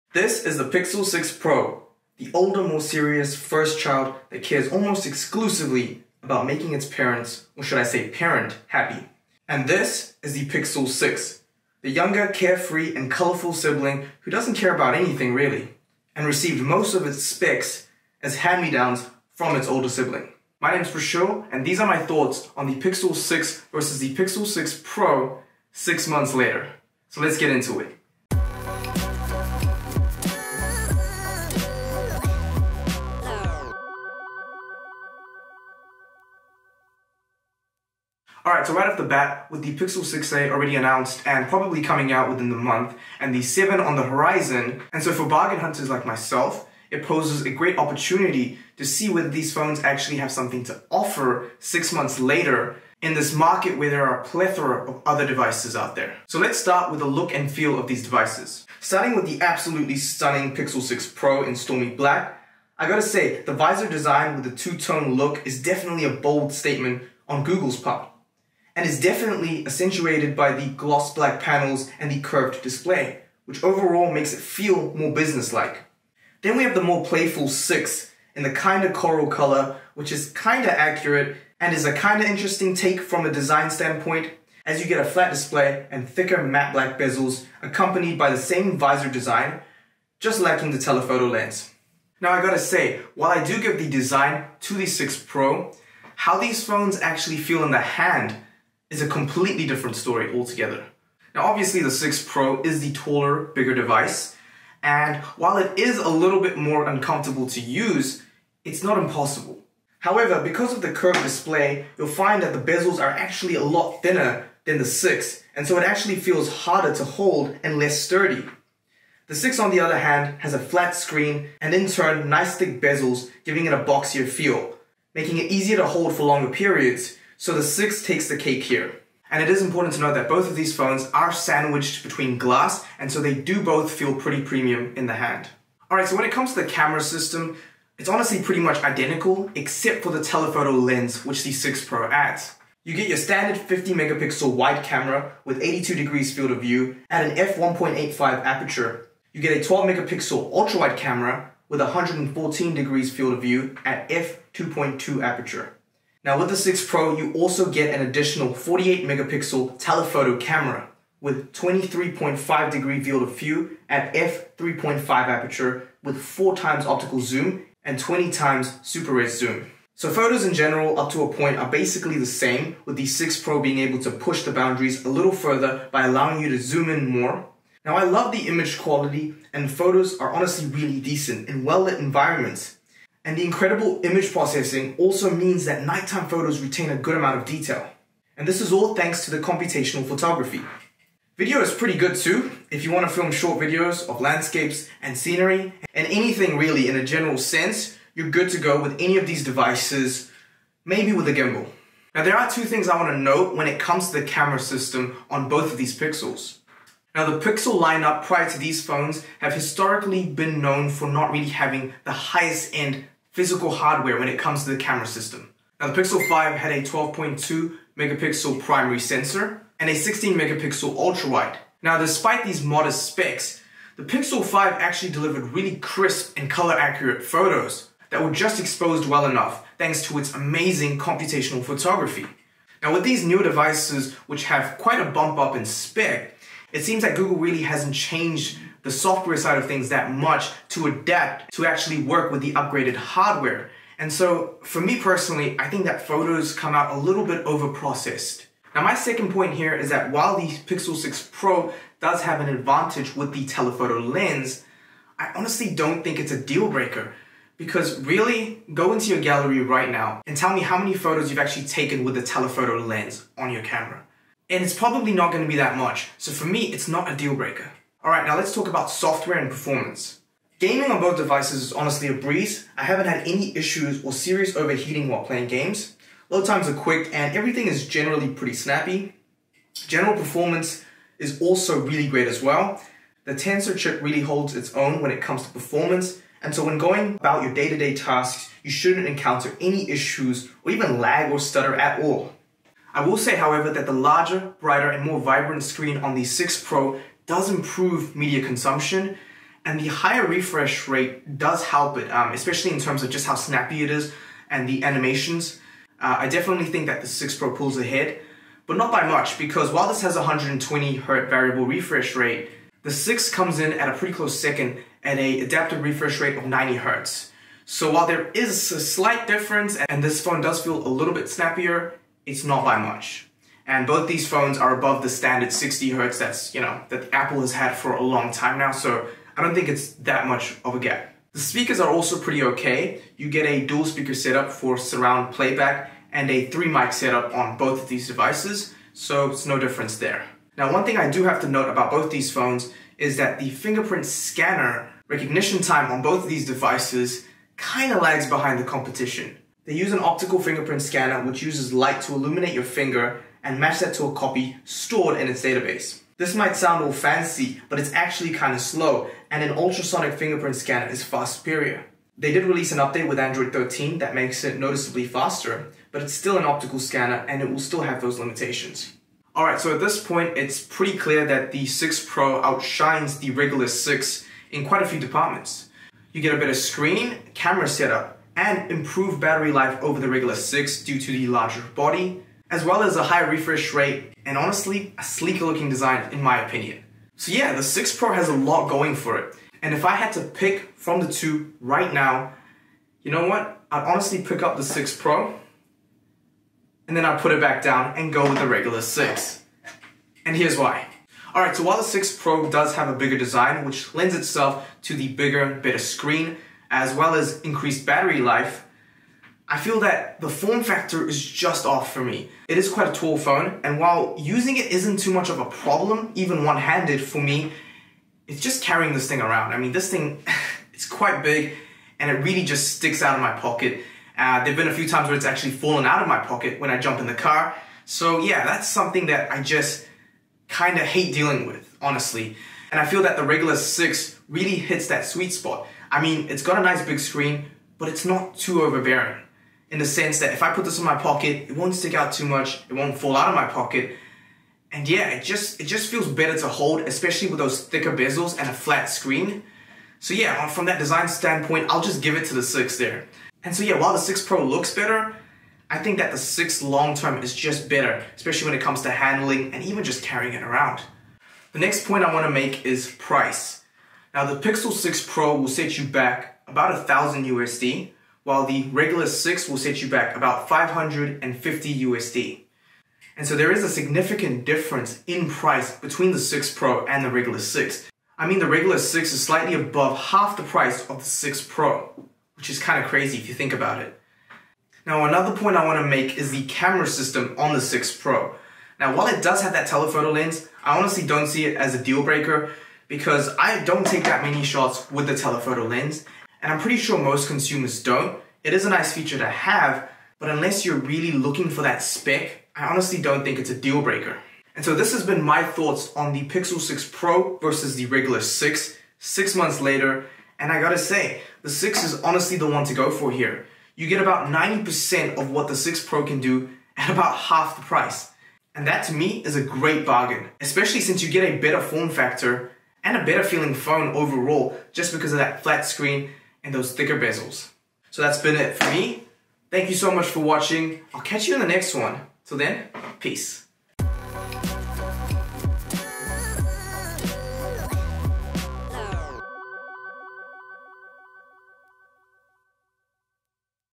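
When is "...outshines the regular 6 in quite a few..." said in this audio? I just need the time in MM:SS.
06:12.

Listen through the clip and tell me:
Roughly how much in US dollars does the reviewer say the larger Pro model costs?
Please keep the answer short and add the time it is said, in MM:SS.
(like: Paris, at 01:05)
1000 USD, at 07:46.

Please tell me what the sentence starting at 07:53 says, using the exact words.
And so there is a significant difference in price between the 6 Pro and the regular 6.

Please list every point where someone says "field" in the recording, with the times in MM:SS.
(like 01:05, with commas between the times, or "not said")
02:26, 02:33, 02:43.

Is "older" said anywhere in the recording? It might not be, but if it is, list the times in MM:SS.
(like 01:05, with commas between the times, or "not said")
00:02, 00:19.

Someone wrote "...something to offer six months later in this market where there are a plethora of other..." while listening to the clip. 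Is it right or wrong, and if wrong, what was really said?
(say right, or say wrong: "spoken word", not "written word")
right.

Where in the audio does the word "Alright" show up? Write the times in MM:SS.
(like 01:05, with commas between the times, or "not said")
00:38, 02:15, 06:09, 06:41.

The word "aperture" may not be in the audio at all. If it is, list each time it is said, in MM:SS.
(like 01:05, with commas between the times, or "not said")
02:28, 02:35, 02:45.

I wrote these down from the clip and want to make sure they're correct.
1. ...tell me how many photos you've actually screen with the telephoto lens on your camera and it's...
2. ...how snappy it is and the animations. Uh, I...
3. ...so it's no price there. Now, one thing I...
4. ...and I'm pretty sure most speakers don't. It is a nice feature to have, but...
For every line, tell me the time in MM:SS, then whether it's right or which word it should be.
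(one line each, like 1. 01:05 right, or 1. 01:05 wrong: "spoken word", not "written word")
1. 04:20 wrong: "taken", not "screen"
2. 05:03 right
3. 05:38 wrong: "difference", not "price"
4. 08:16 wrong: "consumers", not "speakers".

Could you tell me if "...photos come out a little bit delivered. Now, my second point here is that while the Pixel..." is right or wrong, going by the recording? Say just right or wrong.
wrong.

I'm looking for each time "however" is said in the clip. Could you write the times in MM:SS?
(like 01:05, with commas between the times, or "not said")
01:49, 04:53.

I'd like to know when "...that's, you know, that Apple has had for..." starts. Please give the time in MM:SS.
05:26.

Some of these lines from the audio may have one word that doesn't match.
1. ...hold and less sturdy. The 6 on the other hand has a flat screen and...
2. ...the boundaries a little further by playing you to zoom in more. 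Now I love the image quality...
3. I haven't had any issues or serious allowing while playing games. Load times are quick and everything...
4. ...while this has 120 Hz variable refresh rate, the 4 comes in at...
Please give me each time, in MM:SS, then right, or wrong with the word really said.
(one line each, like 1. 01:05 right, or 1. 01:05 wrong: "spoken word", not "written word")
1. 01:57 right
2. 02:54 wrong: "allowing", not "playing"
3. 04:32 wrong: "overheating", not "allowing"
4. 05:09 wrong: "6", not "4".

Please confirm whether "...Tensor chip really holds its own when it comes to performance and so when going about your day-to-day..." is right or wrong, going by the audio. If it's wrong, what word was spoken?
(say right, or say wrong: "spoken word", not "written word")
right.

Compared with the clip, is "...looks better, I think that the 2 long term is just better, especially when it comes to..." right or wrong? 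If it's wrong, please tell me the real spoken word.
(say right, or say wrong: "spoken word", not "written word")
wrong: "6", not "2".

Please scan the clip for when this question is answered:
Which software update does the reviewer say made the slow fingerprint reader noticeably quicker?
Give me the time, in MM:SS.
06:03.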